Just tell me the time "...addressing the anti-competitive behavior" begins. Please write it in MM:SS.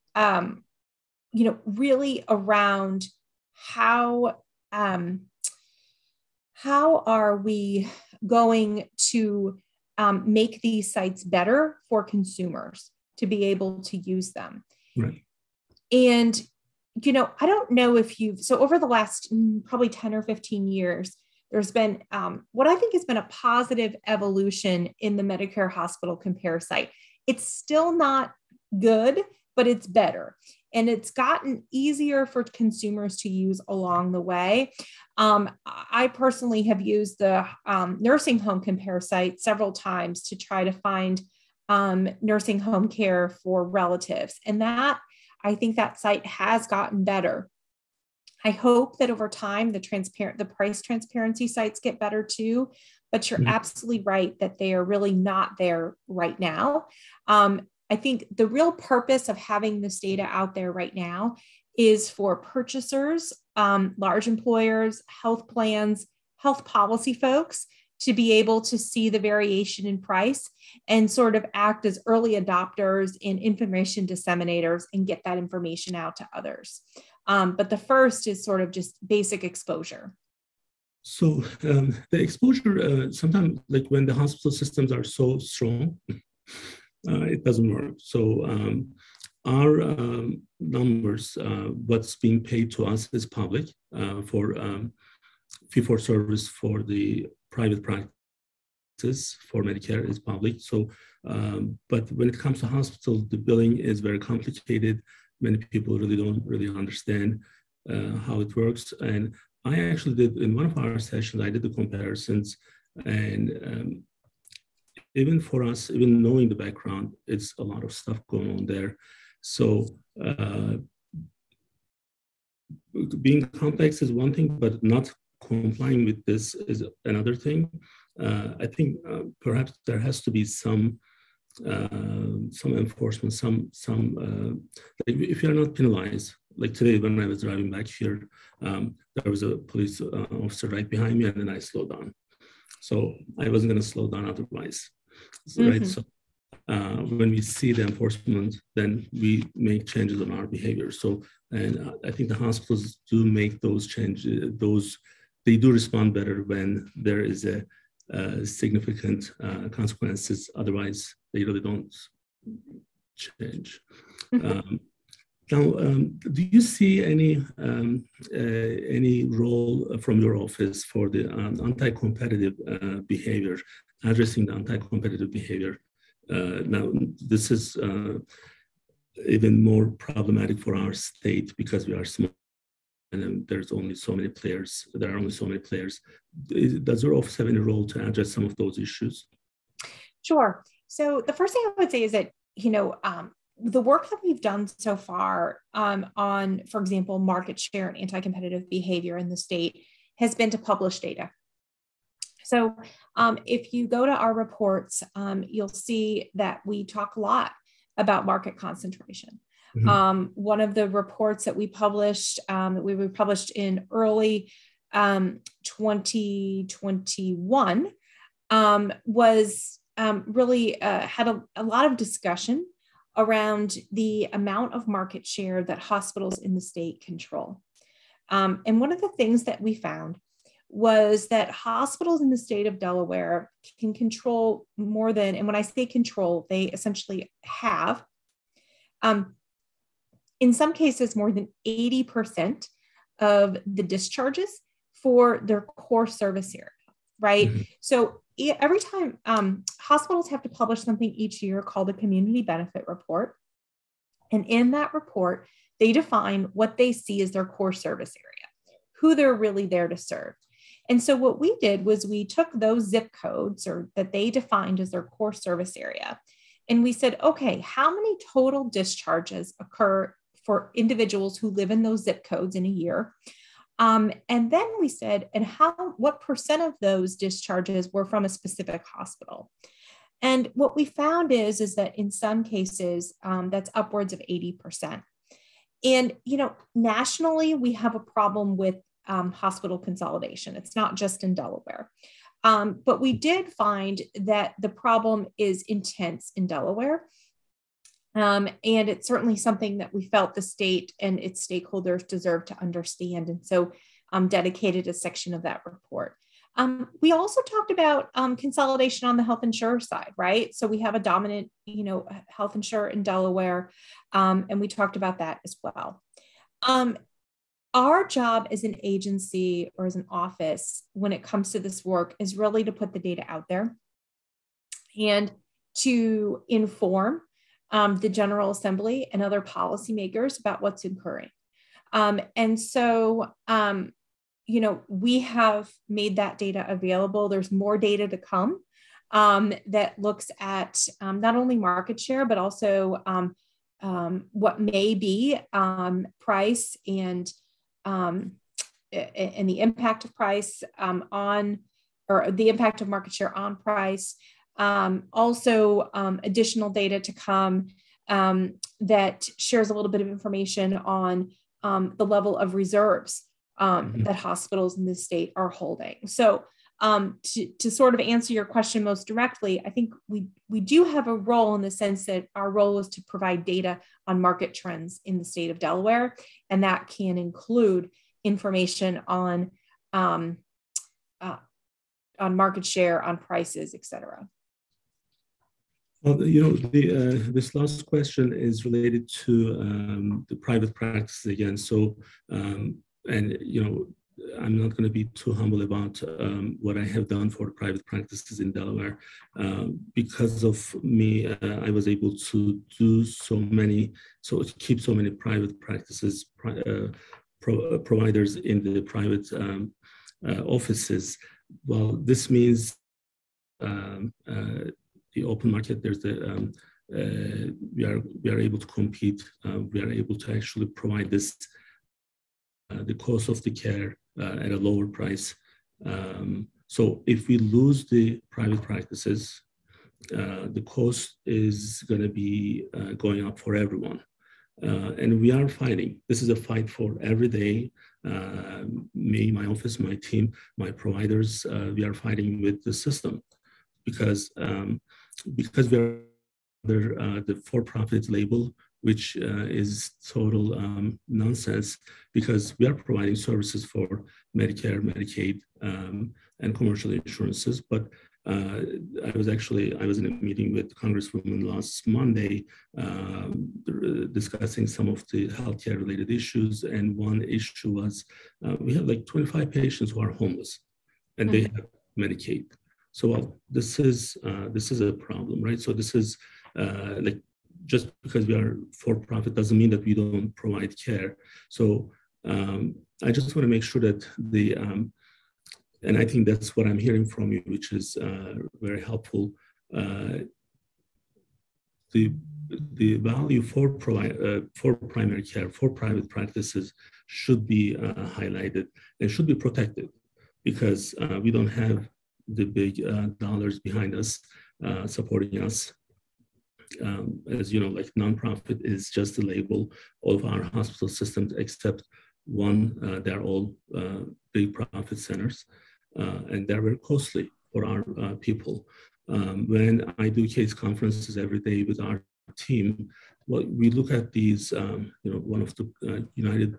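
02:54.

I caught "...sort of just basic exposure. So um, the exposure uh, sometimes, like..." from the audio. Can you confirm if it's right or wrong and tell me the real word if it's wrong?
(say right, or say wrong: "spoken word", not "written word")
right.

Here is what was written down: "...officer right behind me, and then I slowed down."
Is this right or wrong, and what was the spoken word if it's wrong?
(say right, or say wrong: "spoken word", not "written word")
right.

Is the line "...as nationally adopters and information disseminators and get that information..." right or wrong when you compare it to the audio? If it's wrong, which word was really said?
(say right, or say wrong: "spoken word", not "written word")
wrong: "early", not "nationally".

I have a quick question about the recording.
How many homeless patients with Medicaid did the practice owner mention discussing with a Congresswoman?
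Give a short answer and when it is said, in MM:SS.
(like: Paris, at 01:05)
25, at 07:49.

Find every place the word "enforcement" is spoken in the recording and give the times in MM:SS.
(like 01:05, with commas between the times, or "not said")
02:12, 02:27.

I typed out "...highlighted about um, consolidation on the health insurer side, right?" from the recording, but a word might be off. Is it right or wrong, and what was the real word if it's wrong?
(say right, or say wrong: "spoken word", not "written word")
wrong: "talked", not "highlighted".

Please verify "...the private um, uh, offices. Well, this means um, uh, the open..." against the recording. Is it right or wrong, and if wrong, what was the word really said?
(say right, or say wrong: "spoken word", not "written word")
right.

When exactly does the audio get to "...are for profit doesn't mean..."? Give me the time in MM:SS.
07:58.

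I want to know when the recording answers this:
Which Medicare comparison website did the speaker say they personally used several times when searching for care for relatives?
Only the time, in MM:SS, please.
00:37.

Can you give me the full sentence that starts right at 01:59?
So uh, being complex is one thing, but not complying with this is another thing.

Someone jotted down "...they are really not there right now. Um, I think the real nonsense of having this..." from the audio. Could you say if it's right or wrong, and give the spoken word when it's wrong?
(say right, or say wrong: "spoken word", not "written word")
wrong: "purpose", not "nonsense".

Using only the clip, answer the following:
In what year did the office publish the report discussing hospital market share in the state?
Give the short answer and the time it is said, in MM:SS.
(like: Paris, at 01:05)
2021, at 03:35.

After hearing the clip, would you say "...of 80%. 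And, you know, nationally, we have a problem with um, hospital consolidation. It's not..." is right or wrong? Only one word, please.
right.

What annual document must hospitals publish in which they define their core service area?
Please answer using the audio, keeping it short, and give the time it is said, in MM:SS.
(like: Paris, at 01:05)
community benefit report, at 04:11.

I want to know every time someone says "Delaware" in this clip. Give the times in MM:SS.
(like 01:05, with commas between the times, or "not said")
03:52, 04:51, 04:56, 05:13, 06:15, 06:38.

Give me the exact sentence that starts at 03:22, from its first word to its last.
So um, if you go to our reports, um, you'll see that we talk a lot about market concentration.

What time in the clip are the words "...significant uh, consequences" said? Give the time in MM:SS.
02:38.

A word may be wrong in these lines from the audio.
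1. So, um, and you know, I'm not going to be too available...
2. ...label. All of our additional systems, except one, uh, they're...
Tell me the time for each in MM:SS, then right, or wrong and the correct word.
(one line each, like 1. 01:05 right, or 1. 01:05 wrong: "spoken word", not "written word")
1. 06:31 wrong: "humble", not "available"
2. 08:29 wrong: "hospital", not "additional".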